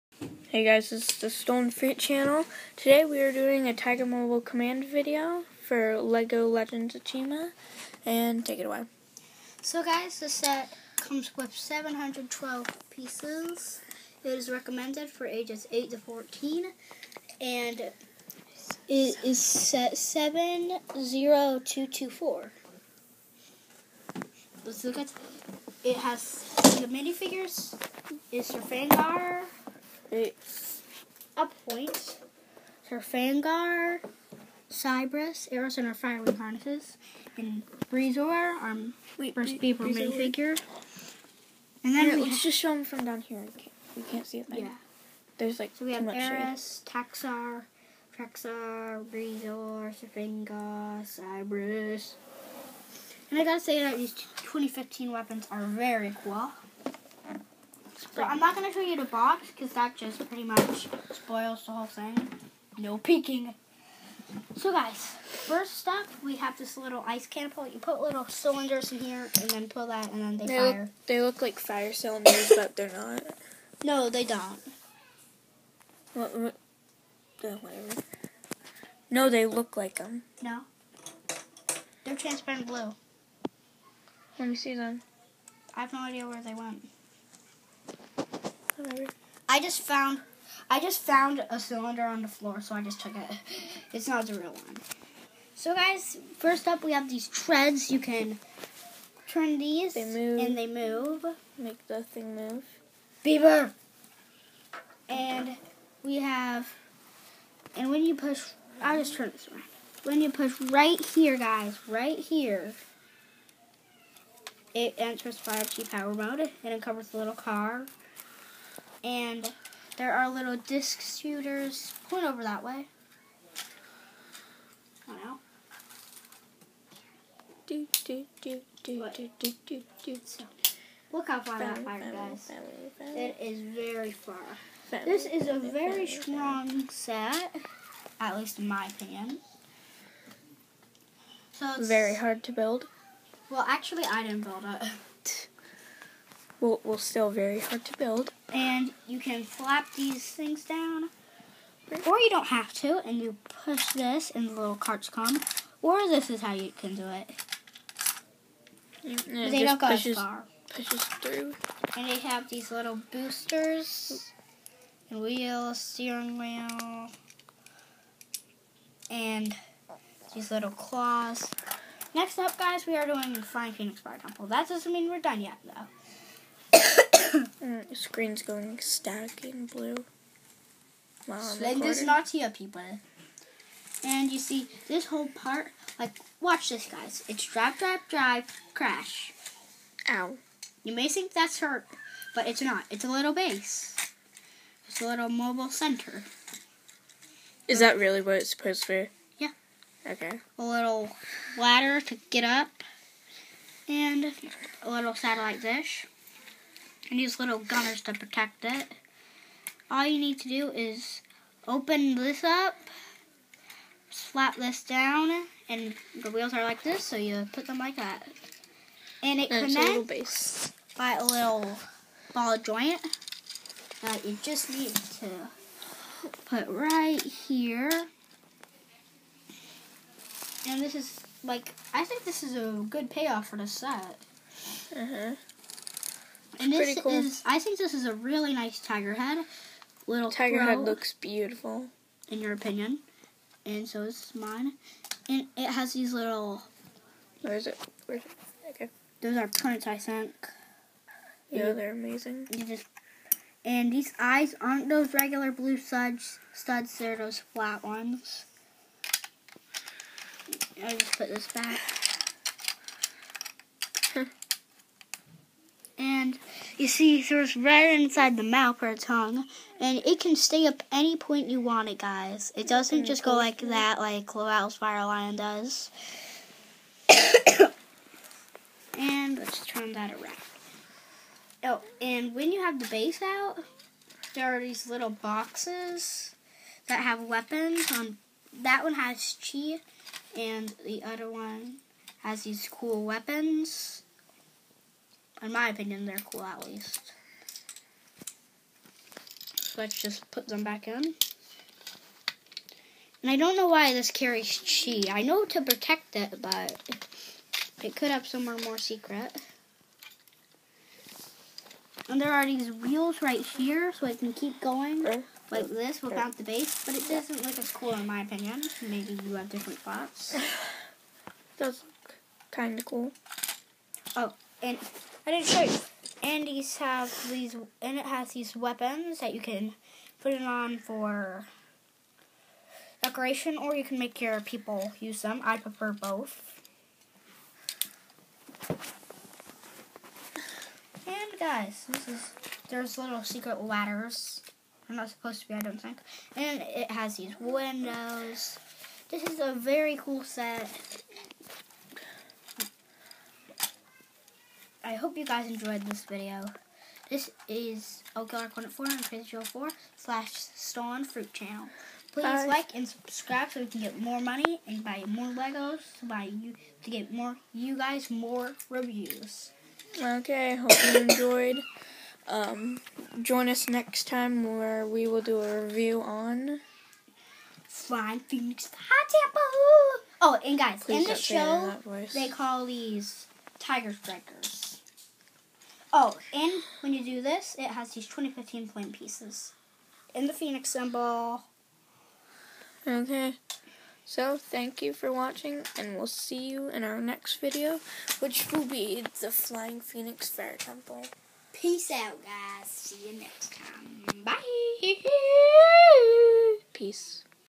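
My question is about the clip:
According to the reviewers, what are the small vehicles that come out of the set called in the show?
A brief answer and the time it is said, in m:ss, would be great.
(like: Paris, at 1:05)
Tiger Strikers, at 6:23.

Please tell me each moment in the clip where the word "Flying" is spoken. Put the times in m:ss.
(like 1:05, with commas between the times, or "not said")
2:53, 6:17, 6:39.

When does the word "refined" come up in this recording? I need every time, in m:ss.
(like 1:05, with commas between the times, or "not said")
not said.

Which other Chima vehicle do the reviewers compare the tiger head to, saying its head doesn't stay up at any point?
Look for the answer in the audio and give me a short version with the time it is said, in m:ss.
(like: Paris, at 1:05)
Laval's Fire Lion, at 4:34.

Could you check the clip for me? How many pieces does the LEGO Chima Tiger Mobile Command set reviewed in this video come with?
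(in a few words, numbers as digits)
712.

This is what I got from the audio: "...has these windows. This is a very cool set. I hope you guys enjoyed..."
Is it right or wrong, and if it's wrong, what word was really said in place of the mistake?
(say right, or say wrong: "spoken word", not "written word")
right.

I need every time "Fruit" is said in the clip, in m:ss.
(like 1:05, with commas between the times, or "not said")
0:01, 6:01.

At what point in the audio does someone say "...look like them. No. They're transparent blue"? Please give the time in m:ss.
1:19.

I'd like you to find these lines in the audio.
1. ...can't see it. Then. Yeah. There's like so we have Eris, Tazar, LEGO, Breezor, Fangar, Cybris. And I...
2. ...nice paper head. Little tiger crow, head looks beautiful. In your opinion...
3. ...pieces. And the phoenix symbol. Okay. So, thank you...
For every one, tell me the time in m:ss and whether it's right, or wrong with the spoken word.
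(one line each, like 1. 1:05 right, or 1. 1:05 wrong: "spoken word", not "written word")
1. 0:44 wrong: "Trakkar", not "LEGO"
2. 3:58 wrong: "tiger", not "paper"
3. 6:28 right.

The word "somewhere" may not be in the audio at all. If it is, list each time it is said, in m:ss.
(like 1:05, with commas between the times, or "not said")
5:08.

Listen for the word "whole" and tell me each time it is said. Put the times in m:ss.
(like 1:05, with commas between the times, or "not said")
1:01, 3:05.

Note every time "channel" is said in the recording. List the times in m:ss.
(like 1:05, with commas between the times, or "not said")
0:01, 6:01.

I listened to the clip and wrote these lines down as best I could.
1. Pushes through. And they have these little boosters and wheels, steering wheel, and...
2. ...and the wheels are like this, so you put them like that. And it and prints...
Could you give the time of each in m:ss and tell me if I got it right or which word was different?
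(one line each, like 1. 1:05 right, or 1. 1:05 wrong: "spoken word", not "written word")
1. 2:40 right
2. 3:35 wrong: "connects", not "prints".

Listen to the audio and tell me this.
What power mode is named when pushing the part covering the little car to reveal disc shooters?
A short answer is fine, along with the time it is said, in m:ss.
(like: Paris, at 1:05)
5G power mode, at 1:55.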